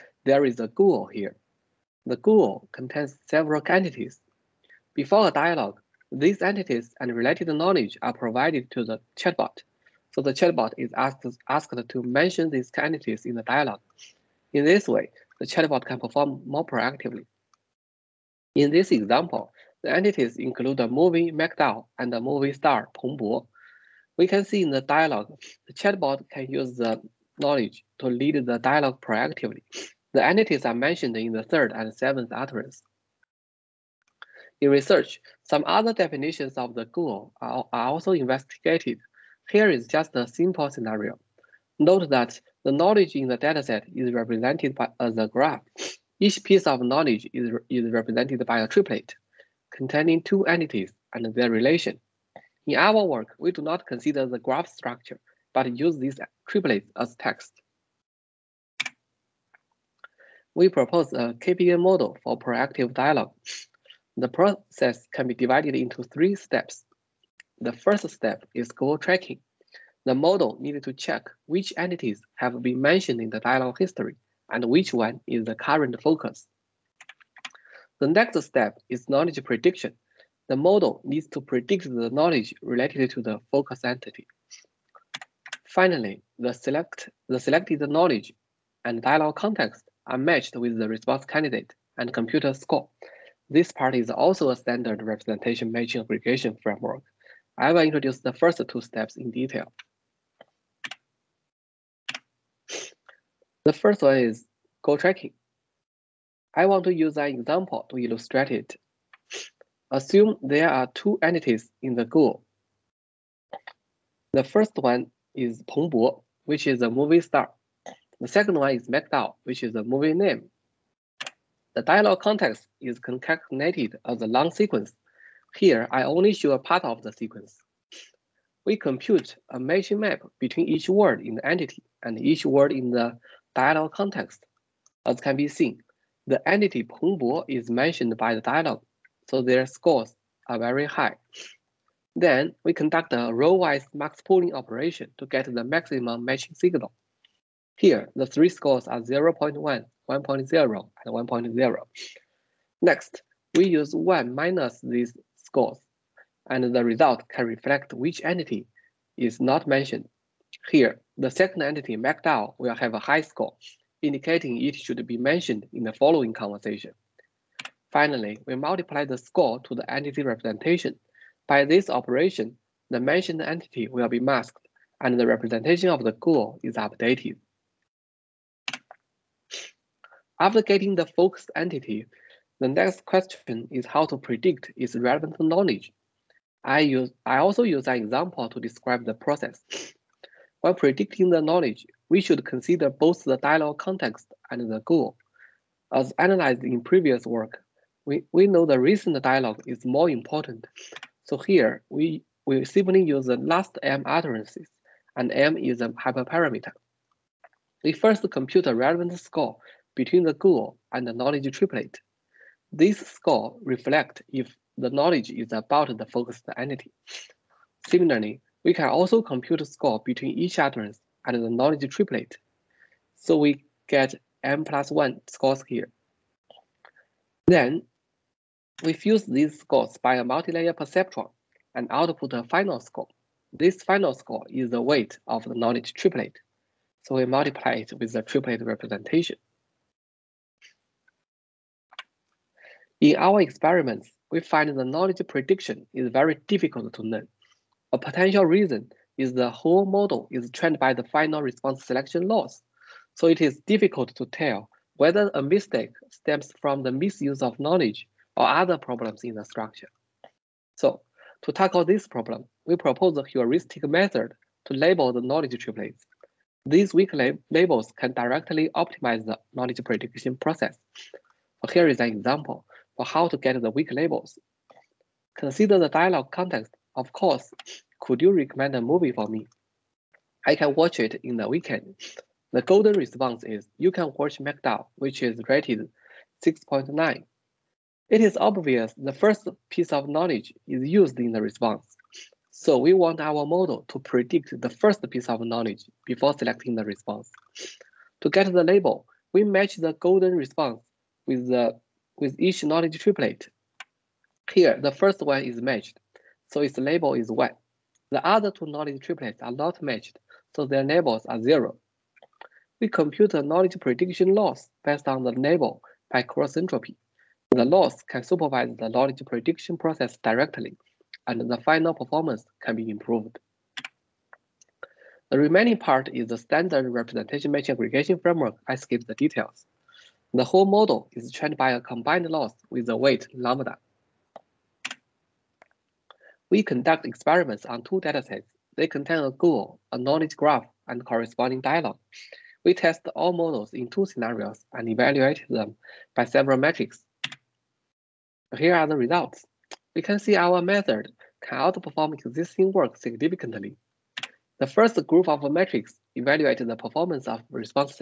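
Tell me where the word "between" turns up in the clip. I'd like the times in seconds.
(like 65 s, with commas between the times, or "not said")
130 s, 209 s, 220 s.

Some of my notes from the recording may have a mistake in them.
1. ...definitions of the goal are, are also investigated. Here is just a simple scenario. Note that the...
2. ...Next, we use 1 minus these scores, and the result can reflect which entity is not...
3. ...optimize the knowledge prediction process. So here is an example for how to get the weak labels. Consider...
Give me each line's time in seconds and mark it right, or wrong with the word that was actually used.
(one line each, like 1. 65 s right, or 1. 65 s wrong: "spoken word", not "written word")
1. 35 s right
2. 152 s right
3. 268 s right.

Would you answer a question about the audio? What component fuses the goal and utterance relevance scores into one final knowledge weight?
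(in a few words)
multilayer perceptron.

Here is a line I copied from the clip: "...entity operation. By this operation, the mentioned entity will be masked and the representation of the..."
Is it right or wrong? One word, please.
wrong.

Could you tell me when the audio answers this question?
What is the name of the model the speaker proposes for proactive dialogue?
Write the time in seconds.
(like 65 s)
61 s.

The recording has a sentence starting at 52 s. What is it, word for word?
In our work, we do not consider the graph structure, but use these triplets as text.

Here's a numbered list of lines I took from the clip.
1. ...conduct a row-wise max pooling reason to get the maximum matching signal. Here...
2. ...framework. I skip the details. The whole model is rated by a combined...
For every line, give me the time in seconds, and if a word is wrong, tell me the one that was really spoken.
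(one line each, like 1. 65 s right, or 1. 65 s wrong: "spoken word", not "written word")
1. 142 s wrong: "operation", not "reason"
2. 328 s wrong: "trained", not "rated".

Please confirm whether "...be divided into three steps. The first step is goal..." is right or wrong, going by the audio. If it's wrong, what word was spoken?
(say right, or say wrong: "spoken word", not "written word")
right.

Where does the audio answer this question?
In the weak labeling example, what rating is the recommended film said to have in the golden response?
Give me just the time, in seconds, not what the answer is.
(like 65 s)
286 s.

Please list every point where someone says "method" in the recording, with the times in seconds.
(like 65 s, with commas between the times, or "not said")
263 s, 350 s.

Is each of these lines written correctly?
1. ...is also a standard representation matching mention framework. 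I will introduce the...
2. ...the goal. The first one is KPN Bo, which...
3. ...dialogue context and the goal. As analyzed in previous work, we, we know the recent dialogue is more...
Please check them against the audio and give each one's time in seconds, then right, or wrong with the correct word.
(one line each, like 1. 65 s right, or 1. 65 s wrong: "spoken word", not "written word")
1. 93 s wrong: "aggregation", not "mention"
2. 111 s wrong: "Peng", not "KPN"
3. 193 s right.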